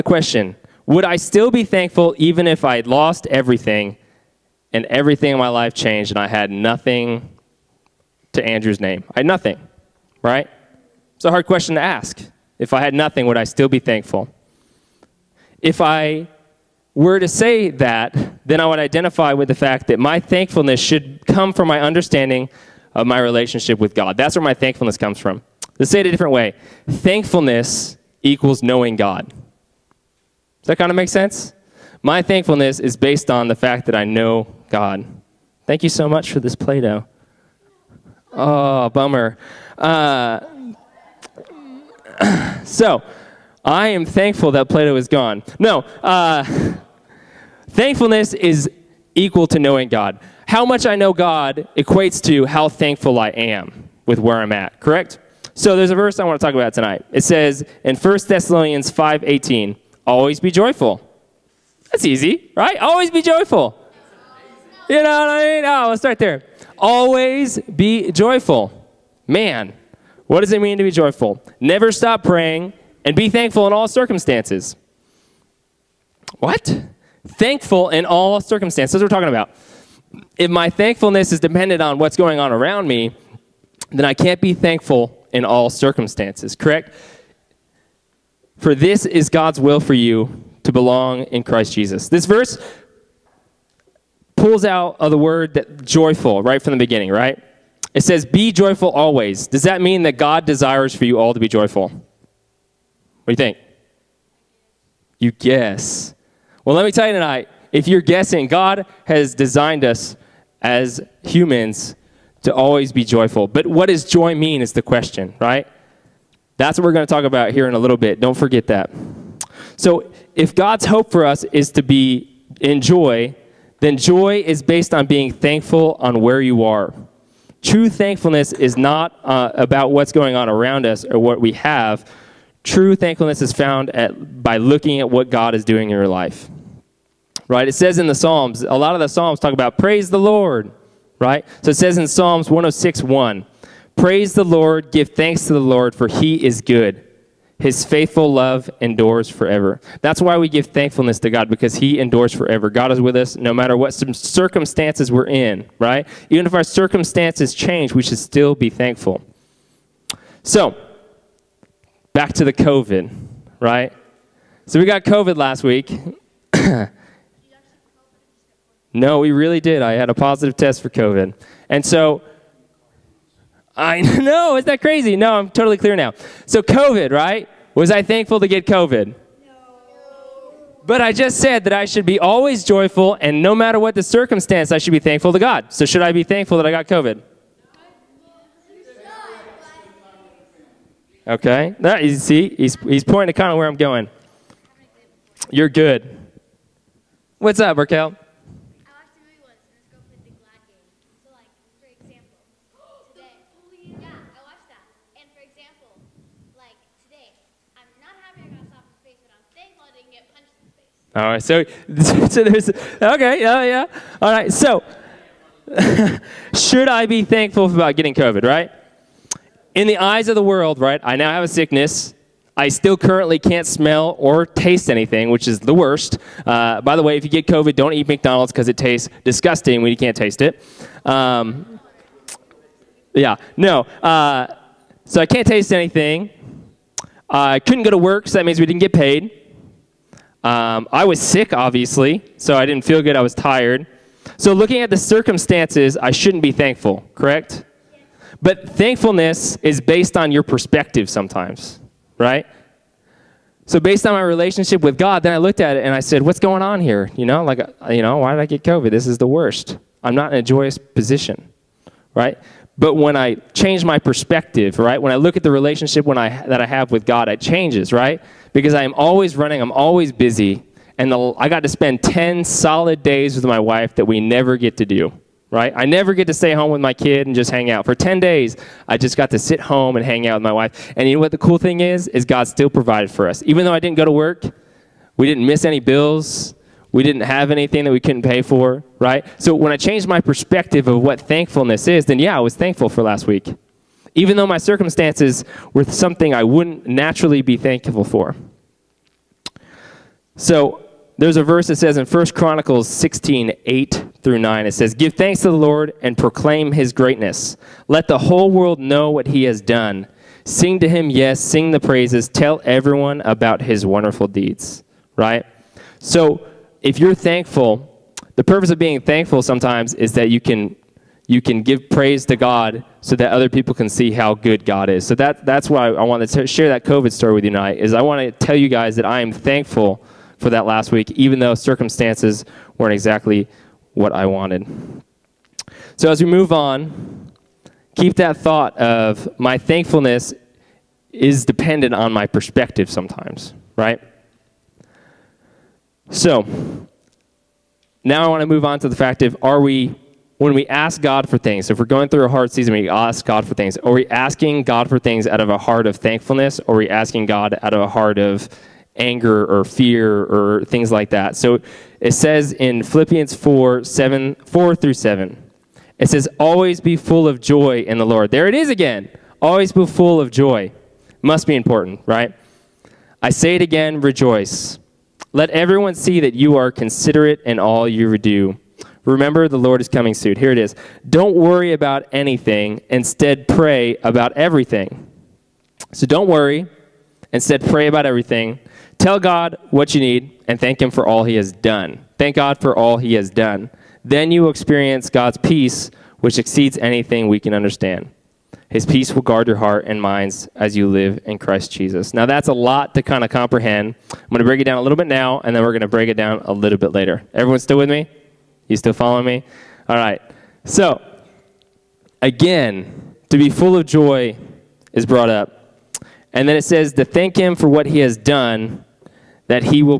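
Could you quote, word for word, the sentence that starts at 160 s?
So, back to the COVID, right?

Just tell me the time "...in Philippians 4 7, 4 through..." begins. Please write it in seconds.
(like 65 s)
362 s.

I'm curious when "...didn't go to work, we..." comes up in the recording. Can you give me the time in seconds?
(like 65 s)
283 s.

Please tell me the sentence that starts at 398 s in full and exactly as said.
His peace will guard your heart and minds as you live in Christ Jesus.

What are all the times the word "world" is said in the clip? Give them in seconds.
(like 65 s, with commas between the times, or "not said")
220 s, 308 s.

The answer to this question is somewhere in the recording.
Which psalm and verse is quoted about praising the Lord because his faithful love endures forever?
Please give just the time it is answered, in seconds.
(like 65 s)
142 s.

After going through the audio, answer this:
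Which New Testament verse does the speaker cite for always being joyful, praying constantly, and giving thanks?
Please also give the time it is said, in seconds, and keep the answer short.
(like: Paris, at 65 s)
1 Thessalonians 5:18, at 57 s.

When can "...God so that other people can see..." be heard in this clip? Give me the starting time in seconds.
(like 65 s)
322 s.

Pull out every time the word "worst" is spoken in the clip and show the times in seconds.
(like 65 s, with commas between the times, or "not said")
225 s, 259 s.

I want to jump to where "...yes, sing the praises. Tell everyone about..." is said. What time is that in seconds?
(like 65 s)
311 s.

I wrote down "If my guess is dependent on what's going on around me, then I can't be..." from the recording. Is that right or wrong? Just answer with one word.
wrong.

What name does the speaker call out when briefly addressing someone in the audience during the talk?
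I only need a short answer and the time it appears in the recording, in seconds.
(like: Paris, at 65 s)
Raquel, at 197 s.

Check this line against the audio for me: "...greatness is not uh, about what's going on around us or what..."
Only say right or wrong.
wrong.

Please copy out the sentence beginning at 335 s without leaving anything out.
So as we move on, keep that thought of my thankfulness is dependent on my perspective sometimes, right?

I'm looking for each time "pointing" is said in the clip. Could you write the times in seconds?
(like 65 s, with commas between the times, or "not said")
193 s.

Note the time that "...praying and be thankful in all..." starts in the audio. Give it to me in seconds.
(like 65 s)
72 s.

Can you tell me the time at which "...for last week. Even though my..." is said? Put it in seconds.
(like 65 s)
292 s.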